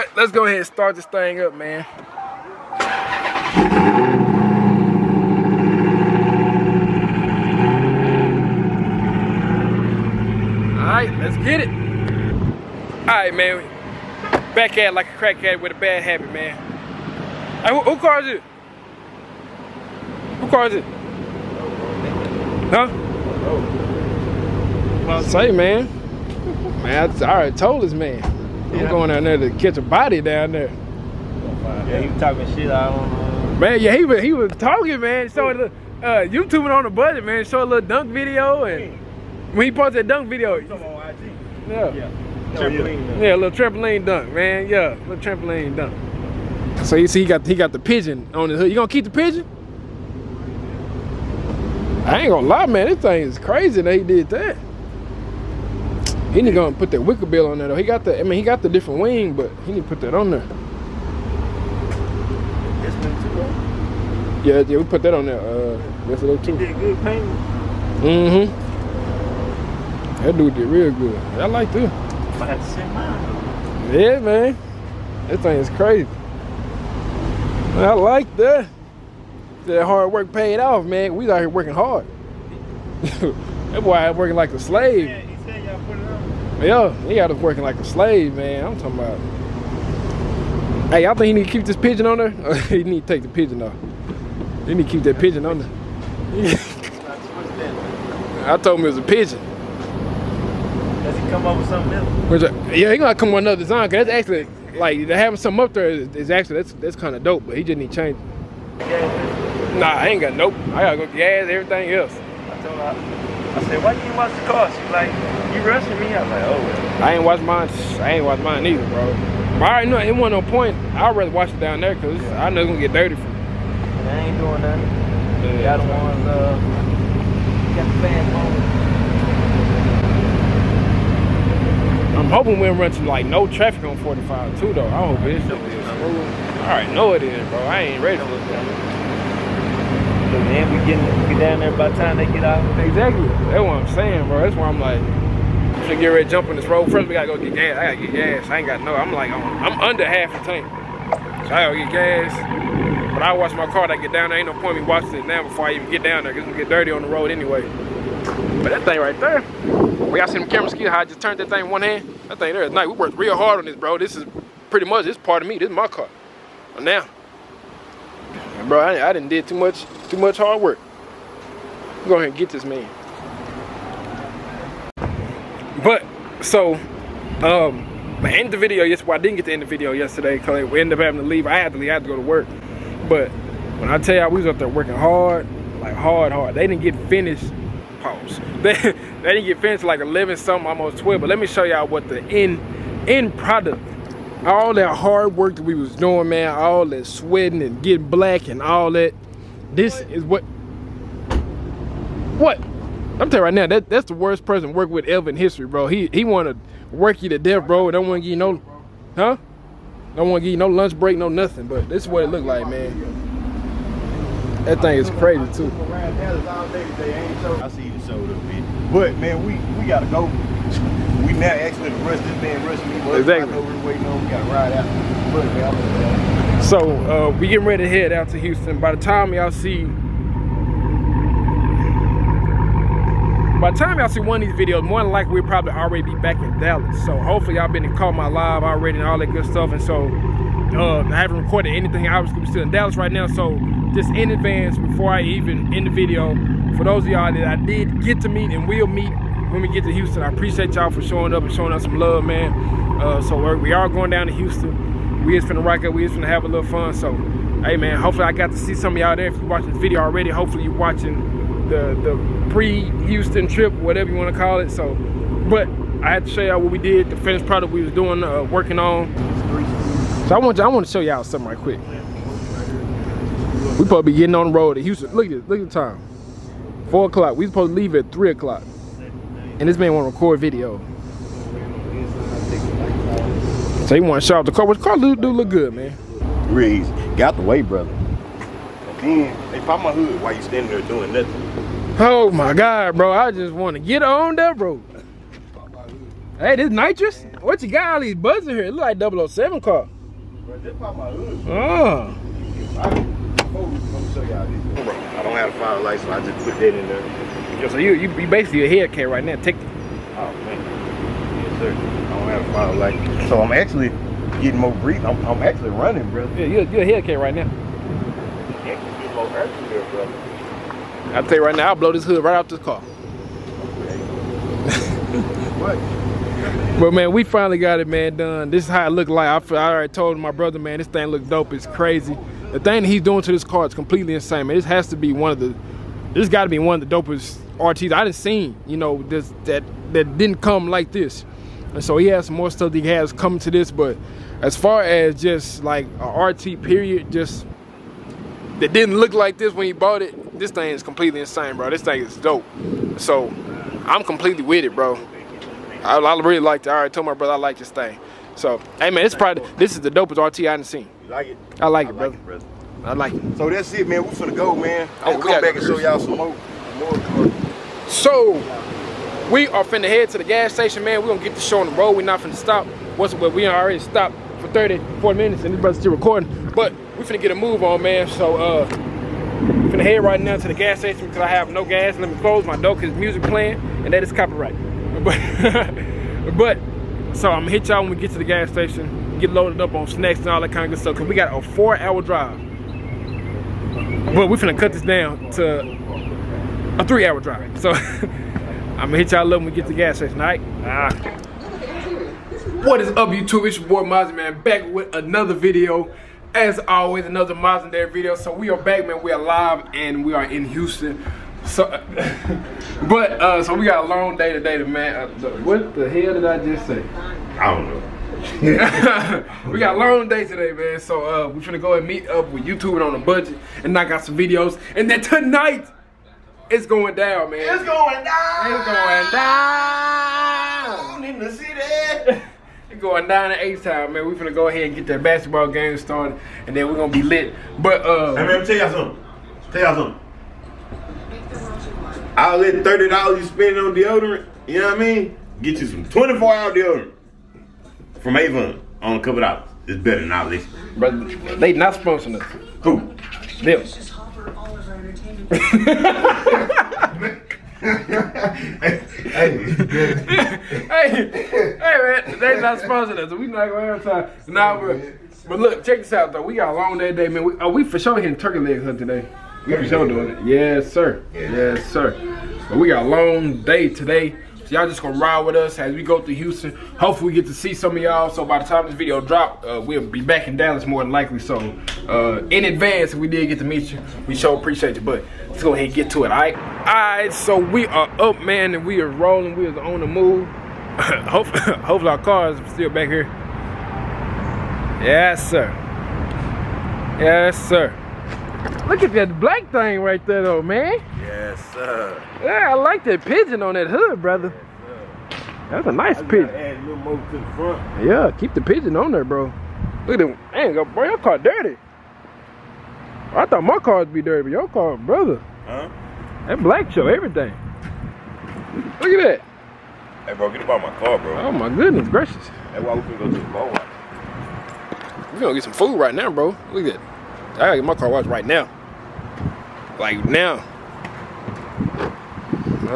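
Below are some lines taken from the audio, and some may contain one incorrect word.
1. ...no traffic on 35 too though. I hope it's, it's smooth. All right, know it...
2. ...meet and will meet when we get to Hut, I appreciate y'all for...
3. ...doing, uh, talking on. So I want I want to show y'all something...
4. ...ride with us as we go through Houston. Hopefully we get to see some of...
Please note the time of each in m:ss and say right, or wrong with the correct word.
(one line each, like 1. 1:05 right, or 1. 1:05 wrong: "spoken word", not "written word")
1. 2:13 wrong: "45", not "35"
2. 4:08 wrong: "Houston", not "Hut"
3. 4:27 wrong: "working", not "talking"
4. 7:54 right.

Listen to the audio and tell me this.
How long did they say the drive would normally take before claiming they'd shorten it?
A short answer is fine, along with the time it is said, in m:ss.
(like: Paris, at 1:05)
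4 hours, at 6:31.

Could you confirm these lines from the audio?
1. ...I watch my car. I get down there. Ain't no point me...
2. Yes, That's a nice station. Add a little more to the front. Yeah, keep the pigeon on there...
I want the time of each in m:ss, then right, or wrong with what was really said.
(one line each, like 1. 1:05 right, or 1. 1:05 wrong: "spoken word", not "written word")
1. 2:33 right
2. 8:25 wrong: "pigeon", not "station".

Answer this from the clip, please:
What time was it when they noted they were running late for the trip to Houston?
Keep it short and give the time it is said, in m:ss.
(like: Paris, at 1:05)
4 o'clock, at 4:36.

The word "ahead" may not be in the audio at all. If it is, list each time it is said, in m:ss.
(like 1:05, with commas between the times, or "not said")
0:00, 2:52, 7:14, 8:05.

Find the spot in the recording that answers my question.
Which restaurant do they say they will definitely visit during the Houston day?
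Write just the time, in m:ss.
7:48.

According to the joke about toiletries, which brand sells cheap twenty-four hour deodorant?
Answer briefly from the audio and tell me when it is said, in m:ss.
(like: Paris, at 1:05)
Avon, at 7:28.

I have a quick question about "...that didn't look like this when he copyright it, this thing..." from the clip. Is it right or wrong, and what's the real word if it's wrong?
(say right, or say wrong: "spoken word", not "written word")
wrong: "bought", not "copyright".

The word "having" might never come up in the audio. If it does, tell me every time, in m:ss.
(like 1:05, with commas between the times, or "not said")
1:45, 3:01.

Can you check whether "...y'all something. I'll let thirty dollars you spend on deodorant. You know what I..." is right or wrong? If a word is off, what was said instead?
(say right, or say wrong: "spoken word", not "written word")
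right.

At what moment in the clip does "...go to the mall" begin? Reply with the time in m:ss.
8:42.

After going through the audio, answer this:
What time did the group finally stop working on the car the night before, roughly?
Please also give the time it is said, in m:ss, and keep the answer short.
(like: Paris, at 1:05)
Almost 12, at 3:10.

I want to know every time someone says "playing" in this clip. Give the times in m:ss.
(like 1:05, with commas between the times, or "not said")
6:23.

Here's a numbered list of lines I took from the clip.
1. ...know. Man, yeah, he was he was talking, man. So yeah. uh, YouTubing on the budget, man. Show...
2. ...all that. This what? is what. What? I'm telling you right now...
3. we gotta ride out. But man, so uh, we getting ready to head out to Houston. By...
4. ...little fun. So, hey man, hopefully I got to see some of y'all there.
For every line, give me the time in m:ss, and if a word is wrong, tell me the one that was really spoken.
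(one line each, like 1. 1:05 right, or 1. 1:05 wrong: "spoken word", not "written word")
1. 0:33 right
2. 3:18 right
3. 3:44 right
4. 4:16 right.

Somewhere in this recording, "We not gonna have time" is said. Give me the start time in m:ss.
7:43.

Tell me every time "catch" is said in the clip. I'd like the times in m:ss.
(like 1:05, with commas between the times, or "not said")
0:29.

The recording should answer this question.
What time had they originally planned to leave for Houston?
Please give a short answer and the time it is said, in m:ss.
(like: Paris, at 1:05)
3 o'clock, at 4:38.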